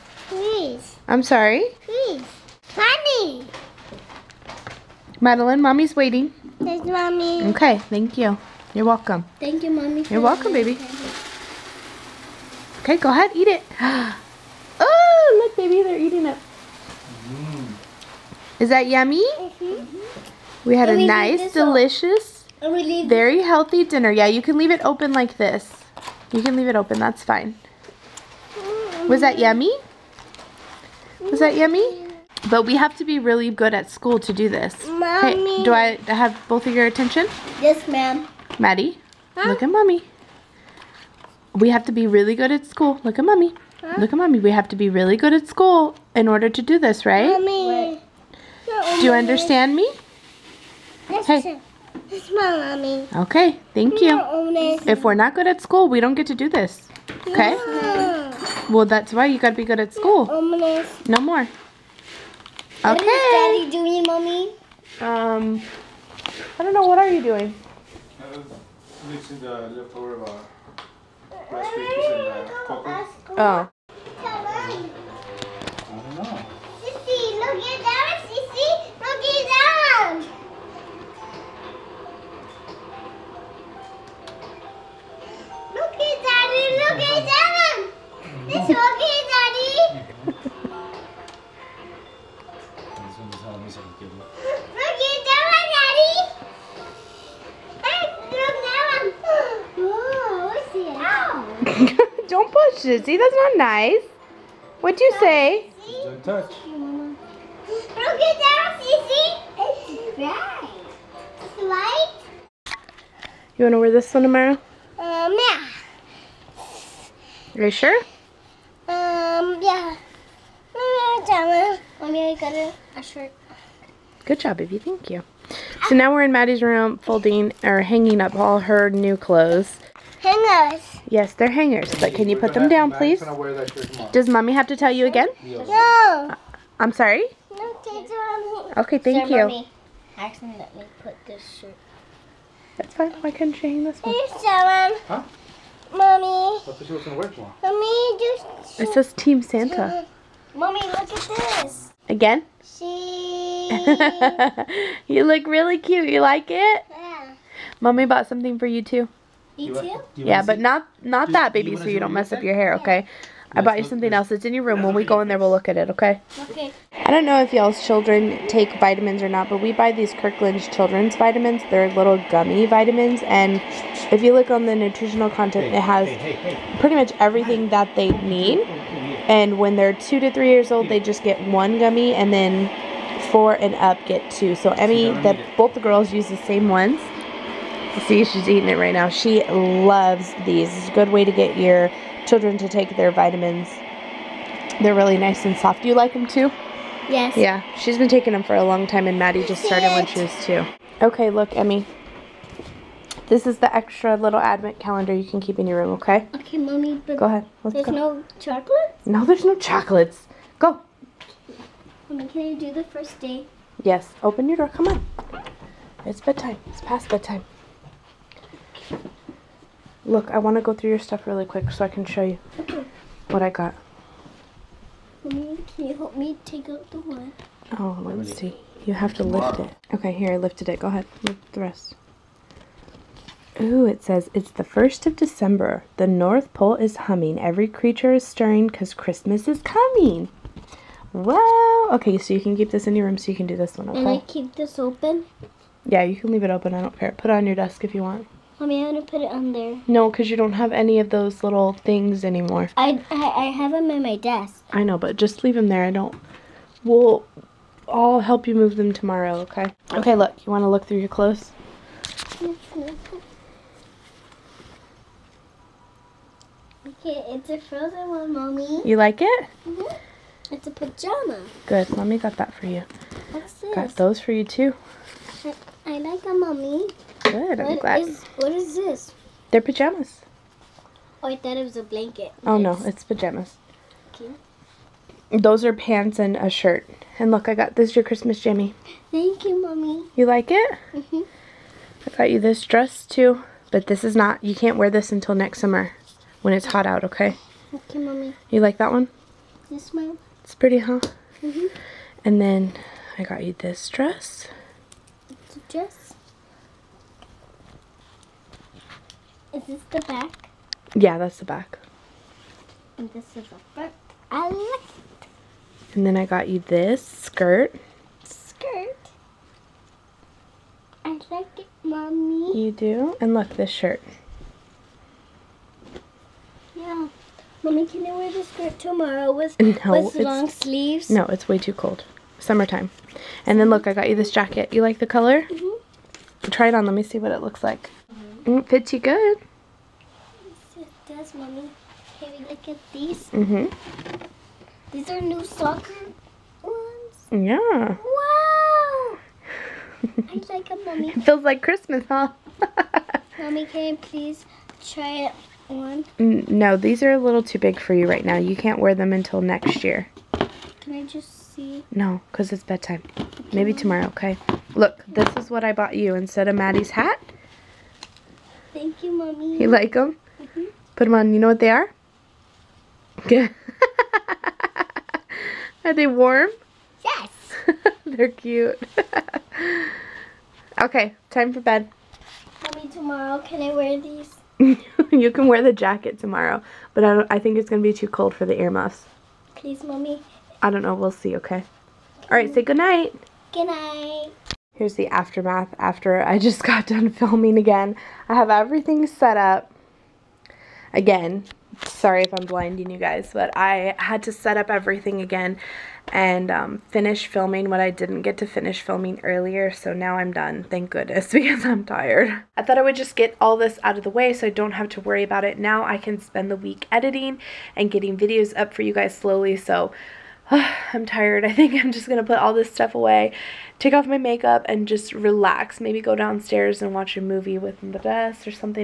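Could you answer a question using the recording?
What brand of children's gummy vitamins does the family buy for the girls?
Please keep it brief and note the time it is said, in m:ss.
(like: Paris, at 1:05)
Kirkland, at 2:50.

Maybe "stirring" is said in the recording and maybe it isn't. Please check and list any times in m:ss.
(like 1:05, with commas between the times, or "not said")
3:58.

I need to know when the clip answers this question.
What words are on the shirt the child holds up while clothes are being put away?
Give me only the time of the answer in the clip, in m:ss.
2:29.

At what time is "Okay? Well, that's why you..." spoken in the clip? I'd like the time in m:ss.
0:57.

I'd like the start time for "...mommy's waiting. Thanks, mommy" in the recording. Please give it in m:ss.
0:05.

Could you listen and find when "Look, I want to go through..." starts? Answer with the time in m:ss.
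3:40.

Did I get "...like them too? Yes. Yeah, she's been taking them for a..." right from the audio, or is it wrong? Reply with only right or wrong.
right.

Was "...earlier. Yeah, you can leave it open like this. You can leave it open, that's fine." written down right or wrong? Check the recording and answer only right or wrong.
wrong.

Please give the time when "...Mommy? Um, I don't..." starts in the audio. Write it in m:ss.
1:04.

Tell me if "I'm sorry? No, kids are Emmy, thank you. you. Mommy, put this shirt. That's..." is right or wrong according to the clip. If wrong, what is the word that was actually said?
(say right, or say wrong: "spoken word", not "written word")
wrong: "Okay", not "Emmy".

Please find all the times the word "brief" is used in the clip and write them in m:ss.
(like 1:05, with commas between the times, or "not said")
not said.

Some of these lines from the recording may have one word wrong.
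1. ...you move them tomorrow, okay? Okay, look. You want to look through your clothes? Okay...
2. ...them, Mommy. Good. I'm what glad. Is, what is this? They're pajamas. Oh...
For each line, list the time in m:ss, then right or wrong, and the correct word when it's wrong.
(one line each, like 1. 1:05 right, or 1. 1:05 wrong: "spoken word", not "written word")
1. 4:18 right
2. 4:36 right.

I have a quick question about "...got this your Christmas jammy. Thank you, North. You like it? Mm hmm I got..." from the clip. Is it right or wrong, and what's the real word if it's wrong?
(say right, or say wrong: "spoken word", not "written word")
wrong: "Mommy", not "North".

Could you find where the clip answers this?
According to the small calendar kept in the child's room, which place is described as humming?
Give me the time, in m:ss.
3:55.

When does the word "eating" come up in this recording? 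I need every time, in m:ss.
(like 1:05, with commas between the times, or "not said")
0:15, 3:08.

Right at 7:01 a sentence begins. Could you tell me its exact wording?
I think I'm just going to put all this stuff away, take off my makeup, and just relax.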